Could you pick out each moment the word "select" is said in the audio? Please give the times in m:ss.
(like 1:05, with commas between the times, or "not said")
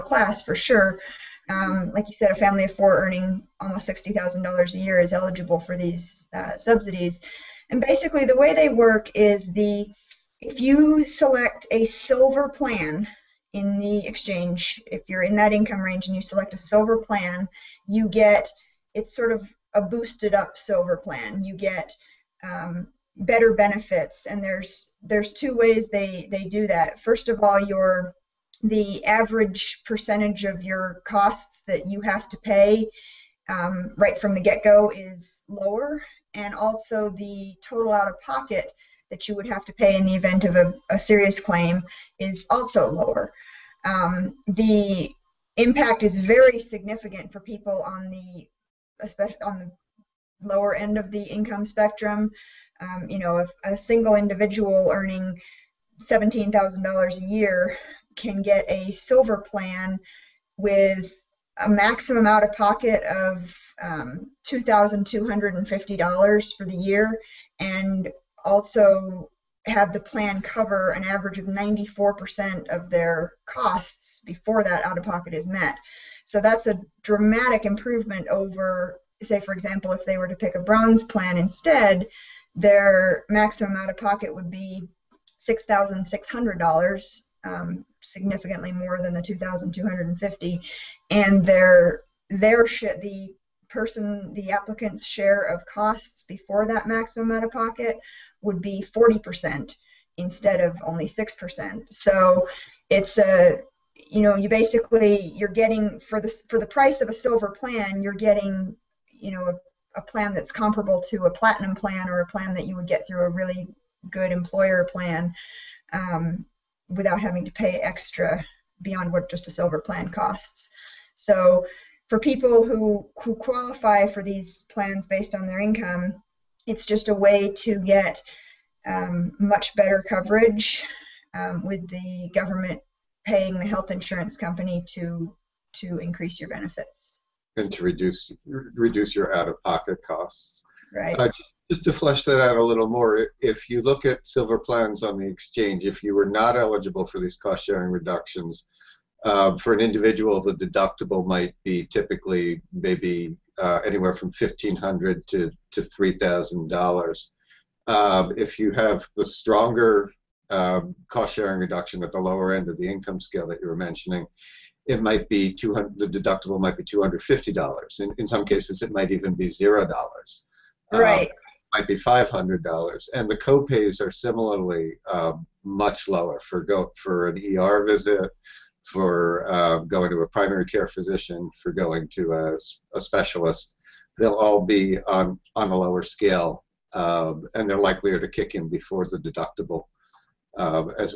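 0:11, 0:16.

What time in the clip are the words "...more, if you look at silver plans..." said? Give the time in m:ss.
2:22.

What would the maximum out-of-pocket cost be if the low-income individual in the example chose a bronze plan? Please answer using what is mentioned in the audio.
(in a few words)
$6,600.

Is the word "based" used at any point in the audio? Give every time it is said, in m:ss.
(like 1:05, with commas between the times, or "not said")
2:05.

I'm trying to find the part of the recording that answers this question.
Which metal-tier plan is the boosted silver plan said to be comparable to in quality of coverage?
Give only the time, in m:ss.
1:51.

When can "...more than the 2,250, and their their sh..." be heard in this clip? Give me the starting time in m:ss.
1:28.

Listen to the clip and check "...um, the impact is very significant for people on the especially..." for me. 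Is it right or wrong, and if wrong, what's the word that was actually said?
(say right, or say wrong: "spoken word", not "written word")
right.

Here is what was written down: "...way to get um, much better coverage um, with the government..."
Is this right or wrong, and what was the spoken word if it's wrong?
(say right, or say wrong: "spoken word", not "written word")
right.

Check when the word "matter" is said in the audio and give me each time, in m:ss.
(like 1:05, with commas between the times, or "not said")
not said.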